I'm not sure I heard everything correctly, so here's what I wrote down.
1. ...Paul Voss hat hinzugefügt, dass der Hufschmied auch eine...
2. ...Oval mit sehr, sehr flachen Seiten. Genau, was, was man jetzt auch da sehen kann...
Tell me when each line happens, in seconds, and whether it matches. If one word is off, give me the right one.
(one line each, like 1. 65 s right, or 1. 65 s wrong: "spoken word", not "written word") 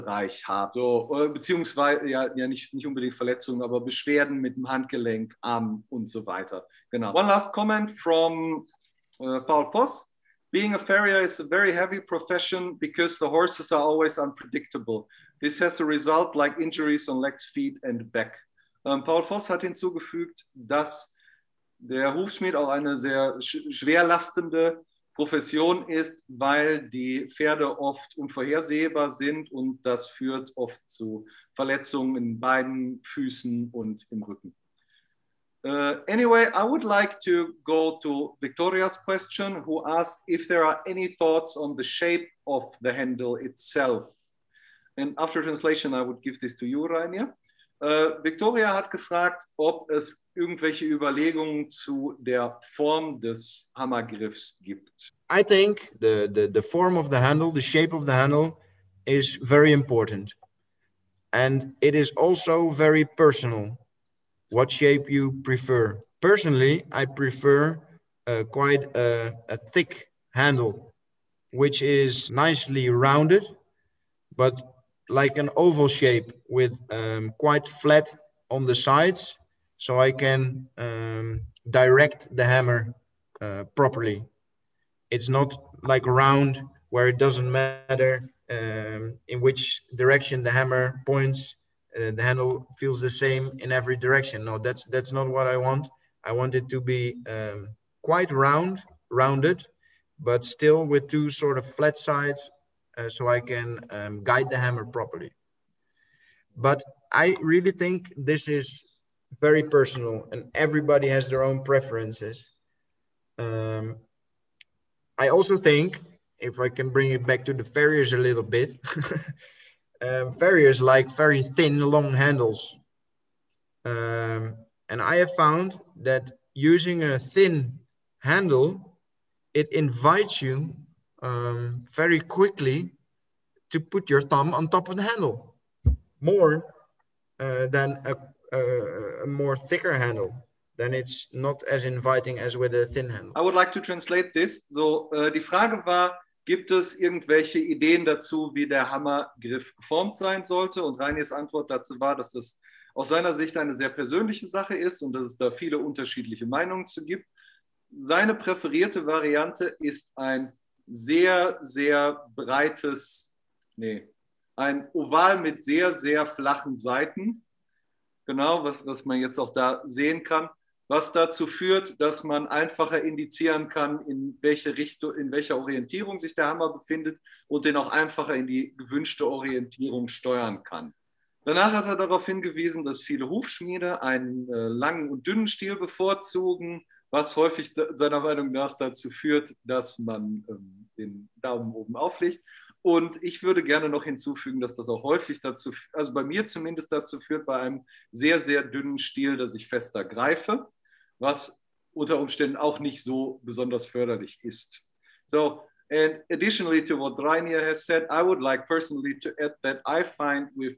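1. 19 s right
2. 164 s right.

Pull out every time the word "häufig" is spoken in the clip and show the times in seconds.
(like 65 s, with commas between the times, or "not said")
187 s, 195 s.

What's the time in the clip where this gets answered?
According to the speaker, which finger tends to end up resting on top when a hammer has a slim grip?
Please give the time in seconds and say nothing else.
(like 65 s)
134 s.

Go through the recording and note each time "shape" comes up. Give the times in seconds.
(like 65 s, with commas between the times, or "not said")
41 s, 57 s, 64 s, 75 s.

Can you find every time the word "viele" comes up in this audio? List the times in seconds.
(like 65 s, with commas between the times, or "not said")
155 s, 183 s.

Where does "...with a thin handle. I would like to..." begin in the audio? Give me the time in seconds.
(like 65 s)
142 s.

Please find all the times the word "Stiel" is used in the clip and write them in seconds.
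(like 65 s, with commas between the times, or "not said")
185 s, 198 s.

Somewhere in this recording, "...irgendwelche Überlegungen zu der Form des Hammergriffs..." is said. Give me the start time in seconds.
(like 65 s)
50 s.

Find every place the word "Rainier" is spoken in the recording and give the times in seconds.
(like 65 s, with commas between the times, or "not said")
46 s, 207 s.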